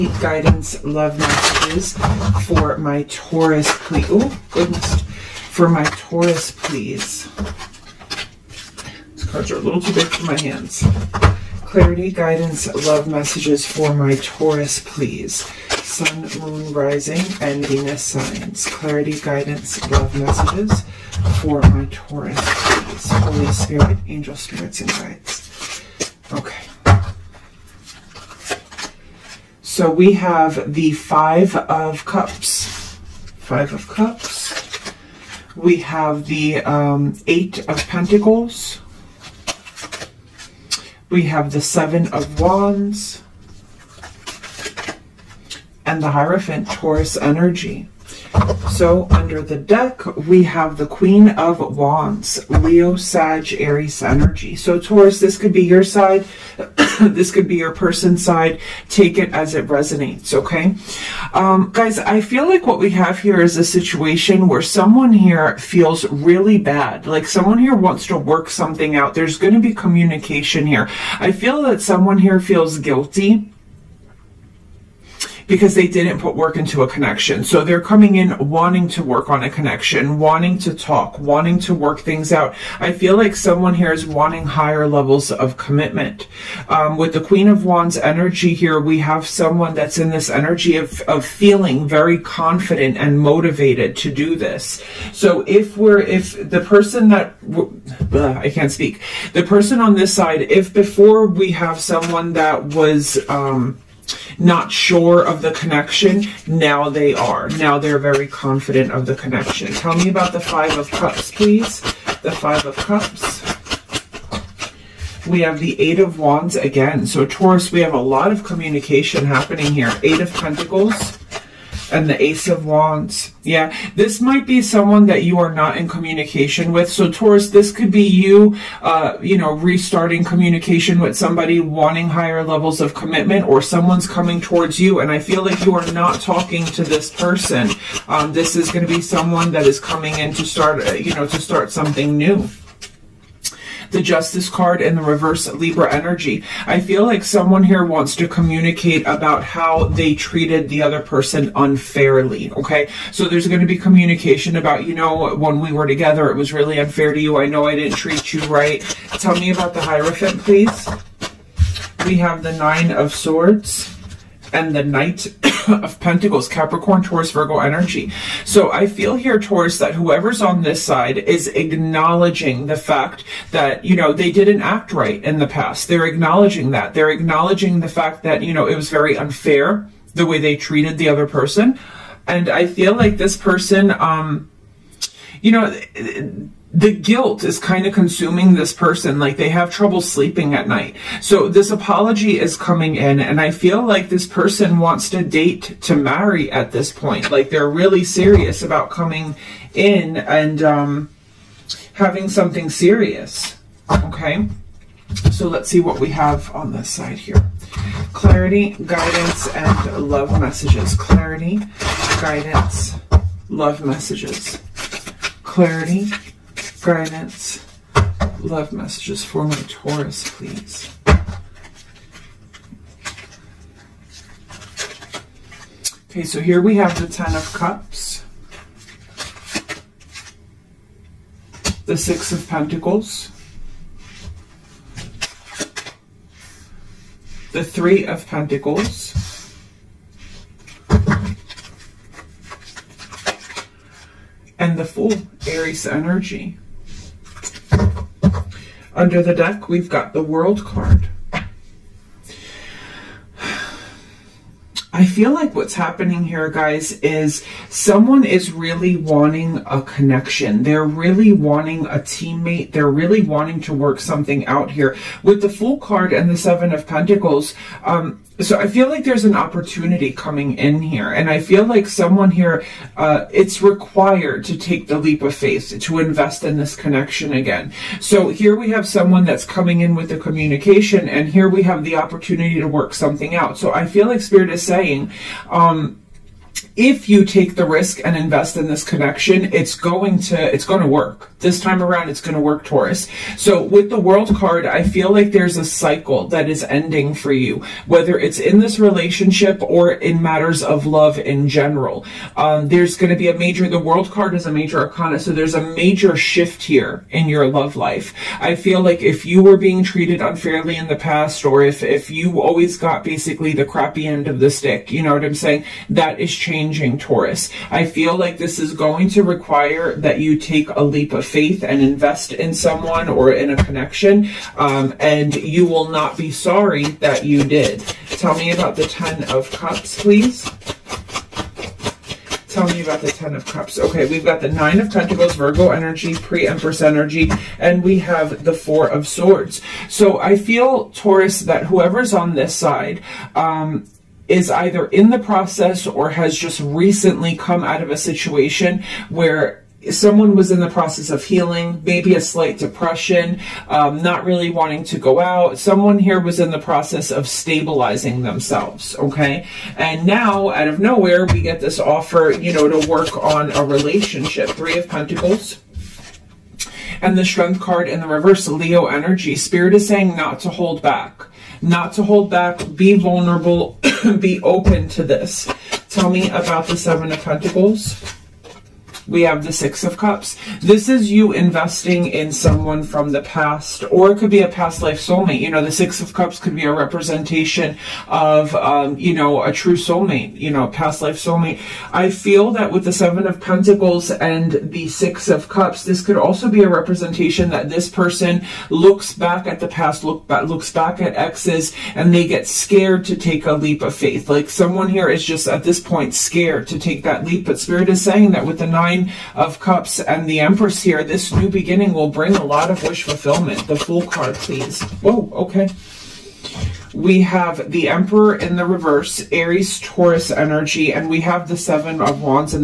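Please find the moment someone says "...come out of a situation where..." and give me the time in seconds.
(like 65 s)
347 s.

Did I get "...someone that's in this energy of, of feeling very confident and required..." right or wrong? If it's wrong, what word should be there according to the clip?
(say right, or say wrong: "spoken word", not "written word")
wrong: "motivated", not "required".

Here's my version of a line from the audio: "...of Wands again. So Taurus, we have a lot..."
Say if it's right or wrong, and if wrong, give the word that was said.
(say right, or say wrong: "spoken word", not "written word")
right.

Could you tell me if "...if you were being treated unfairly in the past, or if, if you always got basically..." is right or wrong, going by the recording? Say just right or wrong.
right.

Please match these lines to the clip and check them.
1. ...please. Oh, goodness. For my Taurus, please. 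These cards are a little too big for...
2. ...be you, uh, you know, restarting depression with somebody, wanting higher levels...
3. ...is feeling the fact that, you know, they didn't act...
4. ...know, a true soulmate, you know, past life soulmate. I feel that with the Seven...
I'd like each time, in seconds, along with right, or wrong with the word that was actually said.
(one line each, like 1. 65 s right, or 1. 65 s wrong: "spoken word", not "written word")
1. 3 s right
2. 127 s wrong: "communication", not "depression"
3. 171 s wrong: "acknowledging", not "feeling"
4. 389 s right.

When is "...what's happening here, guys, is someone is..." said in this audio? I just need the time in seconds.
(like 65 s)
255 s.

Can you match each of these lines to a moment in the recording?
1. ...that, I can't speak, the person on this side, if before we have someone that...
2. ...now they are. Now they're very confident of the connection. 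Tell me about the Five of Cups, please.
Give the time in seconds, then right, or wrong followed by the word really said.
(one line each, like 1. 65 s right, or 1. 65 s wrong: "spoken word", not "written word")
1. 97 s right
2. 106 s right.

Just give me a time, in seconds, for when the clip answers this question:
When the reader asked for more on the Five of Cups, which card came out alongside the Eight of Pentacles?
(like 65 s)
122 s.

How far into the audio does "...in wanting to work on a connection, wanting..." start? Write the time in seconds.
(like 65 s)
78 s.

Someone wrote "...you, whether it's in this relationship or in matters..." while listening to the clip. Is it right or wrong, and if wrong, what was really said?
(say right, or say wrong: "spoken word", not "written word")
right.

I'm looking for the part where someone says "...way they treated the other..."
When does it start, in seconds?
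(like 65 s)
180 s.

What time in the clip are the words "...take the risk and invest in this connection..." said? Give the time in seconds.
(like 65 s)
287 s.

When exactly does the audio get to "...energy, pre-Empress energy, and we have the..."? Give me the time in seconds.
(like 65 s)
335 s.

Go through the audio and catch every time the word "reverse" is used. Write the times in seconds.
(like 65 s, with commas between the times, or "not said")
145 s, 368 s, 418 s.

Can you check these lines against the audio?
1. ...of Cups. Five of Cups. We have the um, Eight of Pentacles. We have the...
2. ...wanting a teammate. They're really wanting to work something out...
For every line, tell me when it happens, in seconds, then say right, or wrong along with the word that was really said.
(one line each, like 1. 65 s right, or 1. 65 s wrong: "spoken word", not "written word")
1. 31 s right
2. 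261 s right.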